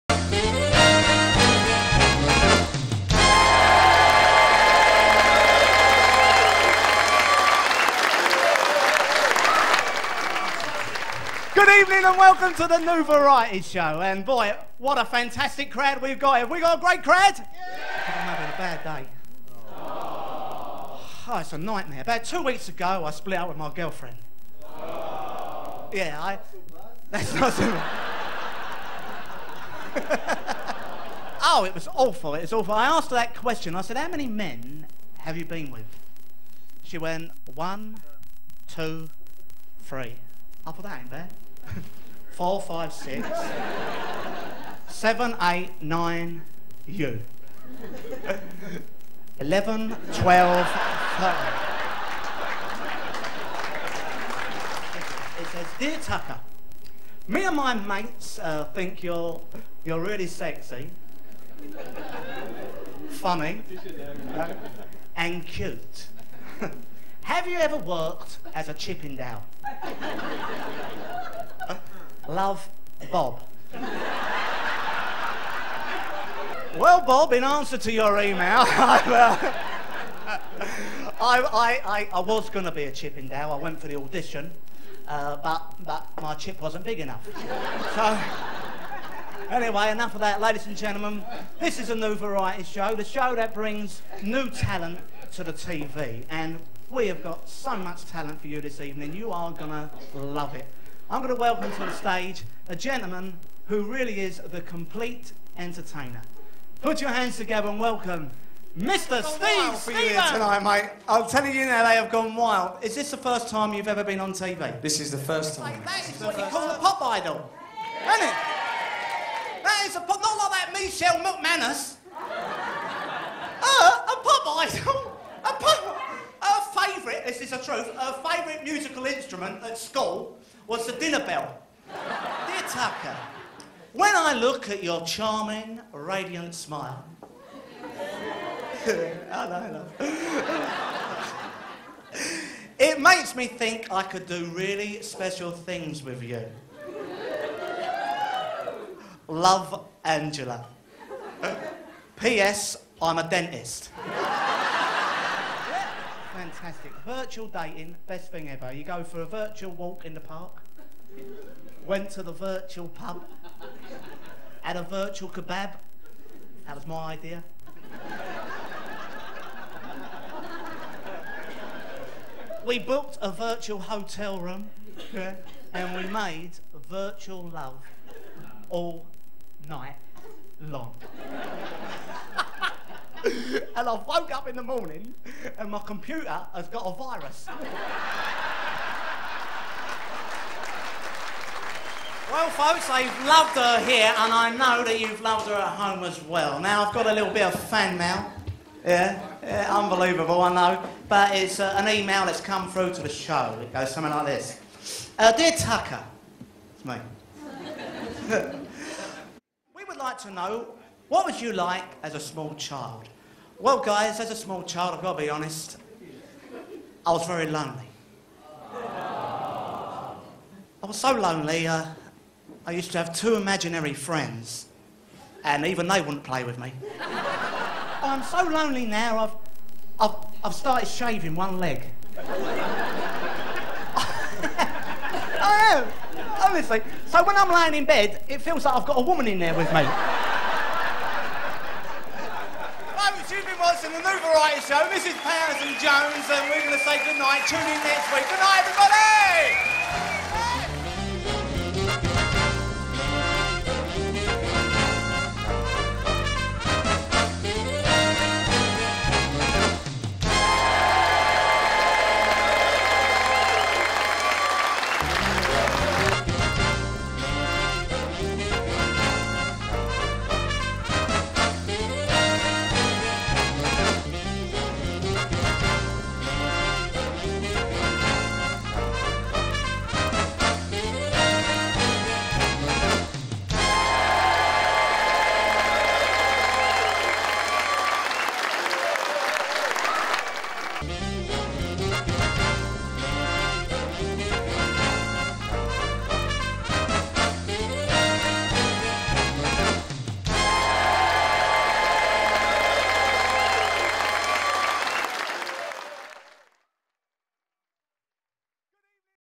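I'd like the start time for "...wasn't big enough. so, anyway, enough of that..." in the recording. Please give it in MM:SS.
01:26.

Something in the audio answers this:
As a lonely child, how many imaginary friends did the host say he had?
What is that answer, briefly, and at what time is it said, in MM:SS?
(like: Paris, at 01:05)
2, at 03:43.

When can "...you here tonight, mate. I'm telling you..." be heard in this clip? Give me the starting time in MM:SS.
01:49.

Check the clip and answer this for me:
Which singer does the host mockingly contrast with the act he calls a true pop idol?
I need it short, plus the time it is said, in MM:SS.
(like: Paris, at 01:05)
Michelle McManus, at 02:00.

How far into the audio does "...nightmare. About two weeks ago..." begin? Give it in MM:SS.
00:21.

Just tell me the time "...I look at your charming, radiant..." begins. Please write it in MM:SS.
02:14.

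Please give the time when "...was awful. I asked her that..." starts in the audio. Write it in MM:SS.
00:32.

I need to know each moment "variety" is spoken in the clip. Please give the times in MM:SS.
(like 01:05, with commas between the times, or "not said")
00:13, 01:32, 04:04.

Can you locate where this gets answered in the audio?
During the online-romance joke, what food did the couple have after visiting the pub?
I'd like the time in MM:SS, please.
02:44.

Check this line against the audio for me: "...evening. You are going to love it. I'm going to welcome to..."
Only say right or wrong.
right.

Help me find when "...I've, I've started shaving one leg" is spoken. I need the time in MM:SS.
03:50.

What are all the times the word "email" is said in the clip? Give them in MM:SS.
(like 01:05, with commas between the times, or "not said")
01:18, 03:21.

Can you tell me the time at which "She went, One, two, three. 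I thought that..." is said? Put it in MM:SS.
00:36.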